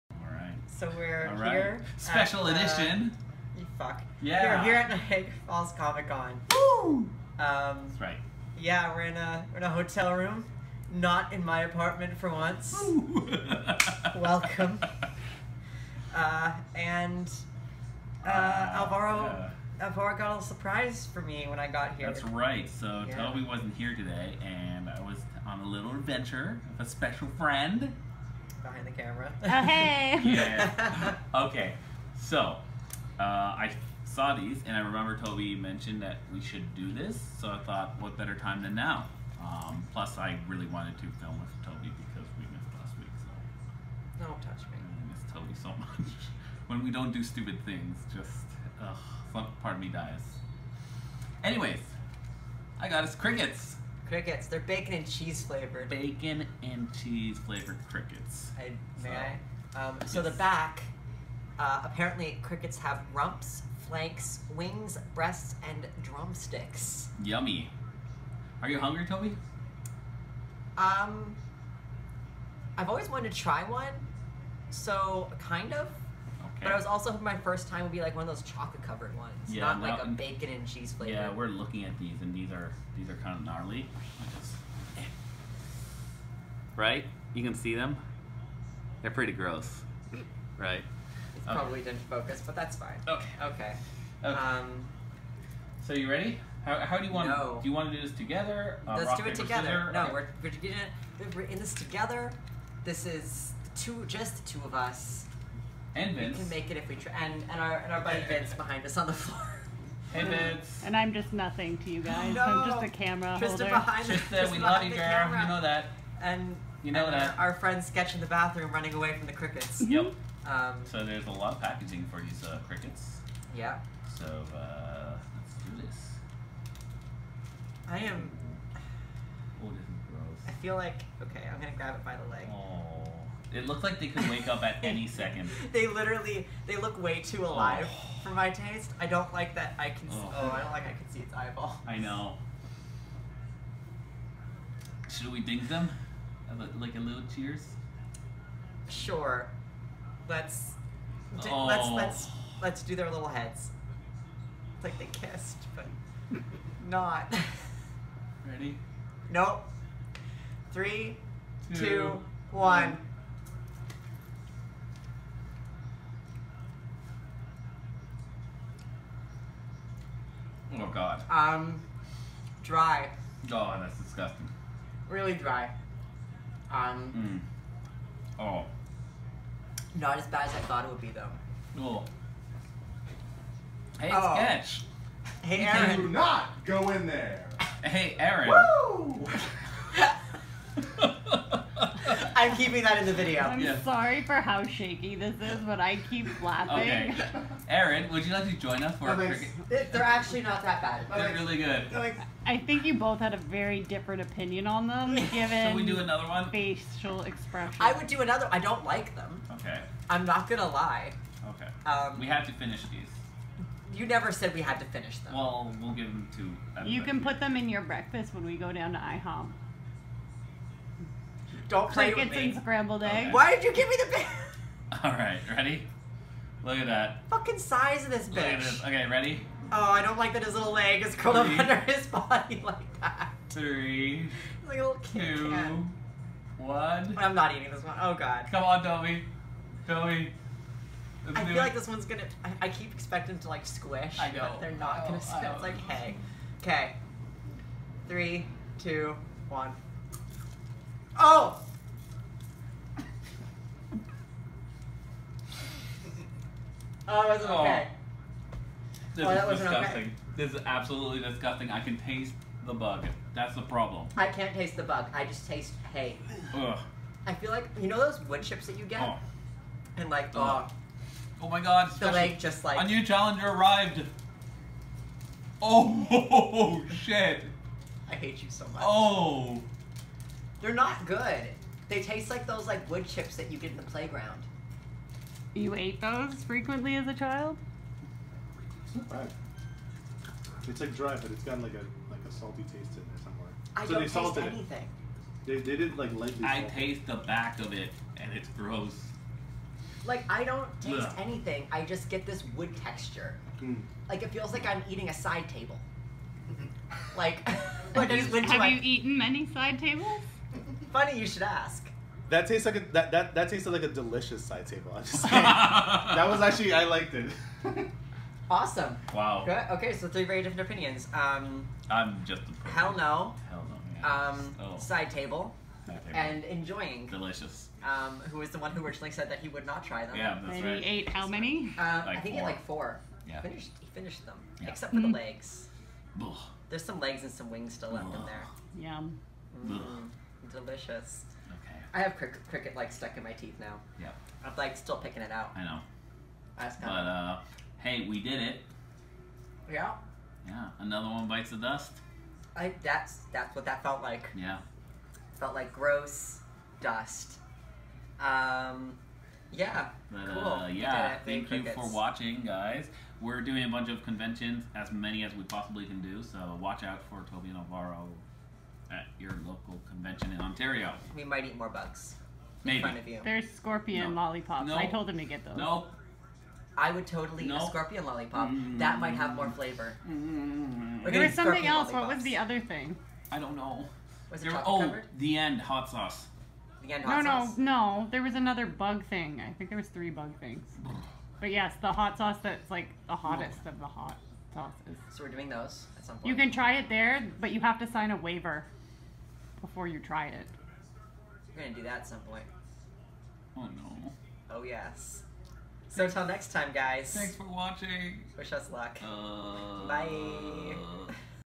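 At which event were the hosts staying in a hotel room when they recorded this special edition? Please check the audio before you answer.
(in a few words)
Niagara Falls Comic Con.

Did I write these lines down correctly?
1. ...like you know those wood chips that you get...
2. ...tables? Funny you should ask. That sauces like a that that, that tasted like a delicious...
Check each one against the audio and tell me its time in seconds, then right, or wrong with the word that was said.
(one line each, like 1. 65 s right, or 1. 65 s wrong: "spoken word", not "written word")
1. 267 s right
2. 309 s wrong: "tastes", not "sauces".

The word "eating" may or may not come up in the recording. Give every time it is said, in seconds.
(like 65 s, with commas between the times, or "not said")
237 s, 304 s.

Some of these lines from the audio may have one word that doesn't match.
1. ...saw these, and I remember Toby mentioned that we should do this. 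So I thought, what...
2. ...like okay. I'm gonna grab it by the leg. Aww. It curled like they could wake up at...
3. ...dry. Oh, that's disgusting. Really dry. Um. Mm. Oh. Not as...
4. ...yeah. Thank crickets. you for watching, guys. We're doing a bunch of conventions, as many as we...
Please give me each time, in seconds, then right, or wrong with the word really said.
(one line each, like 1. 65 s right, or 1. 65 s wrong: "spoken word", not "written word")
1. 34 s right
2. 130 s wrong: "looked", not "curled"
3. 172 s right
4. 360 s right.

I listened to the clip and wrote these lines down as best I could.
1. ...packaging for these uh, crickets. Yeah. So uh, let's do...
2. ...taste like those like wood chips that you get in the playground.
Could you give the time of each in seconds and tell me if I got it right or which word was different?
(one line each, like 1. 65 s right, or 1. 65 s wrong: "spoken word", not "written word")
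1. 121 s right
2. 282 s right.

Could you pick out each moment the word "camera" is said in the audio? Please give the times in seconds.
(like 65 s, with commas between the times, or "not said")
28 s, 112 s.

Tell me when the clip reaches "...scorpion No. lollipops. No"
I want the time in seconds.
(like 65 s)
373 s.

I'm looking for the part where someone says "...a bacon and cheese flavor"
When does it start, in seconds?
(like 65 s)
80 s.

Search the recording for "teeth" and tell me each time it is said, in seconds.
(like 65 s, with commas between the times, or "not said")
343 s.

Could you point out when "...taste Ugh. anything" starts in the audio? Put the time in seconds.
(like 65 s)
300 s.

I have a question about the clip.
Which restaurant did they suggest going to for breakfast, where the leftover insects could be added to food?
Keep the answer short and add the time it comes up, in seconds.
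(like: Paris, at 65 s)
IHOP, at 218 s.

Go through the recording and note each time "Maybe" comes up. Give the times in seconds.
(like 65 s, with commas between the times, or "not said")
372 s.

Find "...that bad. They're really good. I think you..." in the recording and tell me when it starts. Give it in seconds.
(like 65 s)
200 s.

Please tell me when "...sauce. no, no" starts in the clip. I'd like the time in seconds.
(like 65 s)
387 s.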